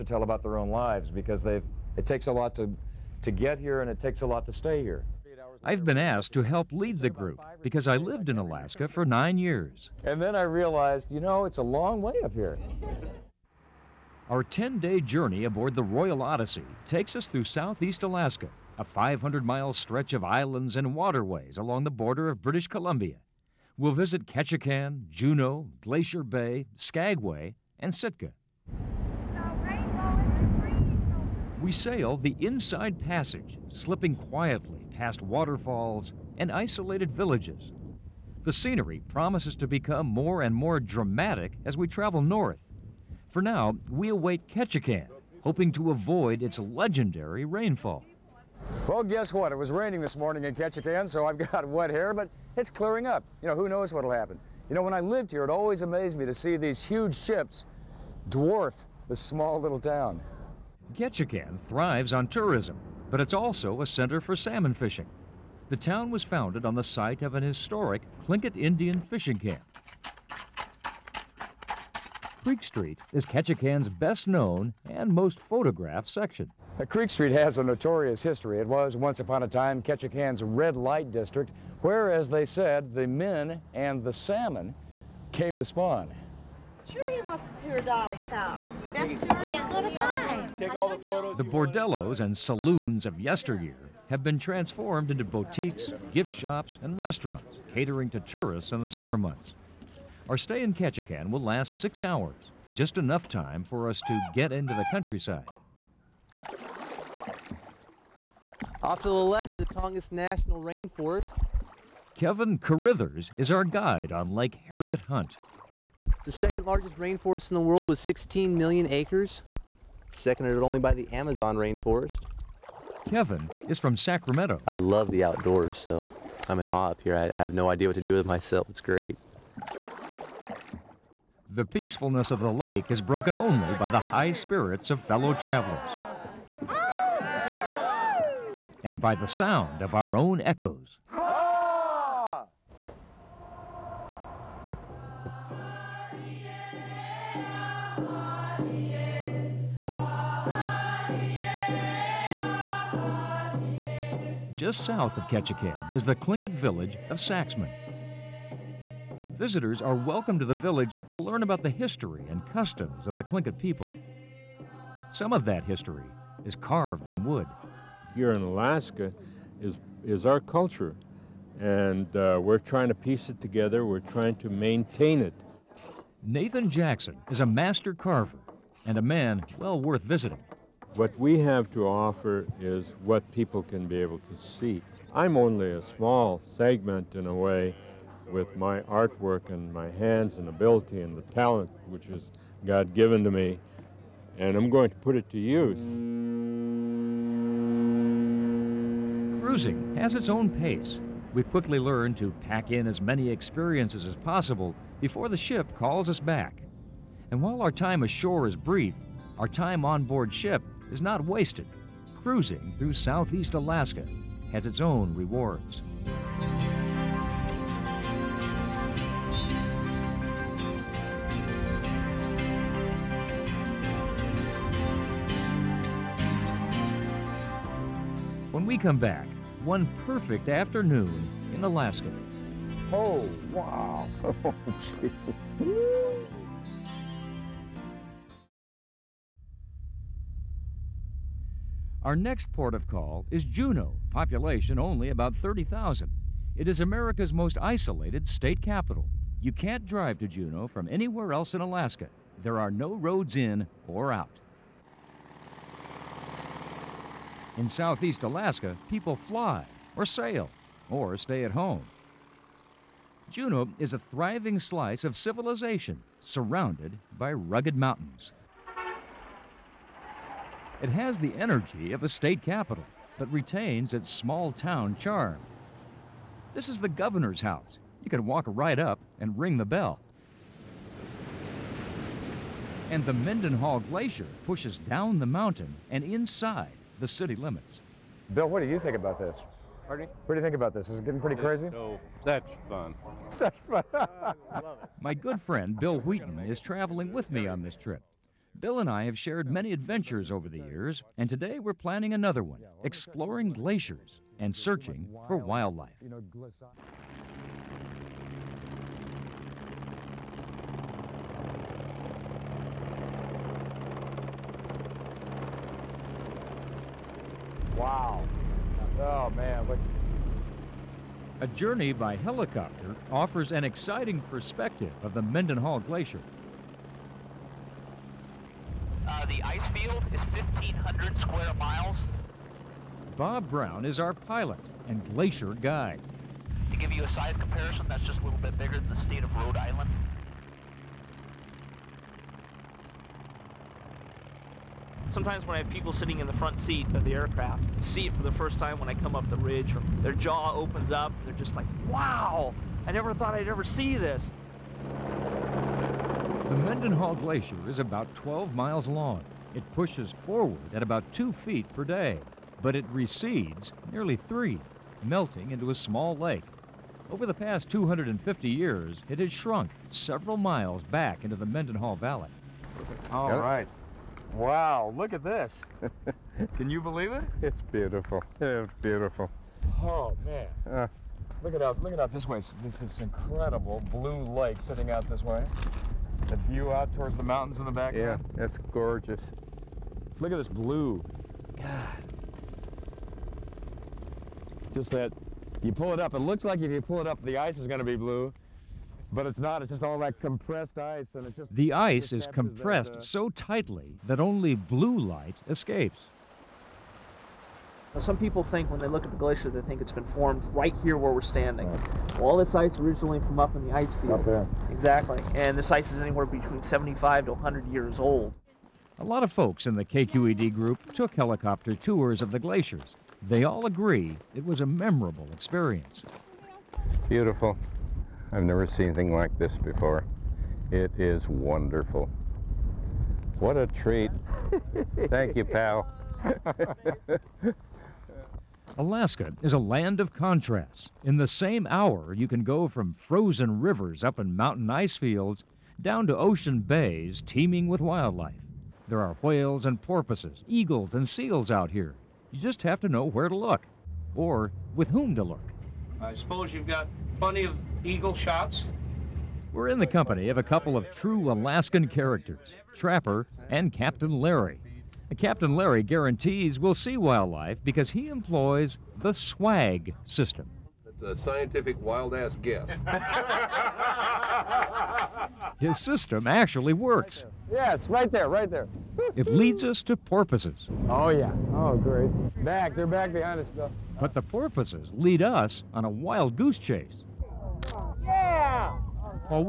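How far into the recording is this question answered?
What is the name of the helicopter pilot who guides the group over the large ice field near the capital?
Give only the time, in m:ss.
5:33.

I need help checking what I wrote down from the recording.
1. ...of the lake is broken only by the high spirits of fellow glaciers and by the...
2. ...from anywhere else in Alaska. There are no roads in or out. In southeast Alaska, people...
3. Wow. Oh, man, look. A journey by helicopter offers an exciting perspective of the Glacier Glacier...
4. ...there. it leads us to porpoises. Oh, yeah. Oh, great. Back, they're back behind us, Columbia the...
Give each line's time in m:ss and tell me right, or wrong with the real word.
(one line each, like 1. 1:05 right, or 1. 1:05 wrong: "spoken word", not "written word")
1. 2:12 wrong: "travelers", not "glaciers"
2. 4:10 right
3. 5:17 wrong: "Mendenhall", not "Glacier"
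4. 7:58 wrong: "But", not "Columbia".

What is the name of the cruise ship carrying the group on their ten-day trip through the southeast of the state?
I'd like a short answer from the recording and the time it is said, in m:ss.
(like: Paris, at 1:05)
Royal Odyssey, at 0:15.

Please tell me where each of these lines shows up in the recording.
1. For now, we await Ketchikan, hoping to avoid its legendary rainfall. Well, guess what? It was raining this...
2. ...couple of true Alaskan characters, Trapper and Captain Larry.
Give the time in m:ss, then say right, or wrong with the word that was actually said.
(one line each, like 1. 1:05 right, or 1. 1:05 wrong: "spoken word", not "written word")
1. 0:43 right
2. 7:40 right.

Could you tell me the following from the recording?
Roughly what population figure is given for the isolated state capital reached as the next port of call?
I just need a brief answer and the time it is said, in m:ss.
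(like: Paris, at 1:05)
30,000, at 4:05.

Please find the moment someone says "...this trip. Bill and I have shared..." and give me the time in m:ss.
4:57.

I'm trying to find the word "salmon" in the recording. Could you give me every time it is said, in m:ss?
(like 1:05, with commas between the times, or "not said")
1:04, 1:24.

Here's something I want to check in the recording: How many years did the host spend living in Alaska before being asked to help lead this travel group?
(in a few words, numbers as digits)
9.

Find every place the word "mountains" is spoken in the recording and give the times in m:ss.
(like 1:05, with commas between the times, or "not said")
4:27, 4:45, 6:27, 7:24.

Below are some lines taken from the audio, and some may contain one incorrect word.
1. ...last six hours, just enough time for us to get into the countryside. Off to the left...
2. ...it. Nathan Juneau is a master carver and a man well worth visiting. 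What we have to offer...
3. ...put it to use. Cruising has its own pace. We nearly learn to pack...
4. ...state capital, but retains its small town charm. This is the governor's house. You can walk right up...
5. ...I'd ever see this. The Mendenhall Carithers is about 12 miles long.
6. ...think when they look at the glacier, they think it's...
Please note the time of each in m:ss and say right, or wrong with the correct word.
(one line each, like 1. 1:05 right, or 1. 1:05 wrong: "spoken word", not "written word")
1. 1:41 right
2. 2:55 wrong: "Jackson", not "Juneau"
3. 3:14 wrong: "quickly", not "nearly"
4. 4:32 right
5. 5:53 wrong: "Glacier", not "Carithers"
6. 6:48 right.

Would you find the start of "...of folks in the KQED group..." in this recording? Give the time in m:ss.
6:59.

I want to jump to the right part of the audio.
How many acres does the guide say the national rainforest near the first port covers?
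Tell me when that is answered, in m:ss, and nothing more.
1:57.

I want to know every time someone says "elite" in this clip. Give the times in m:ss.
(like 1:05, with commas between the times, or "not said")
not said.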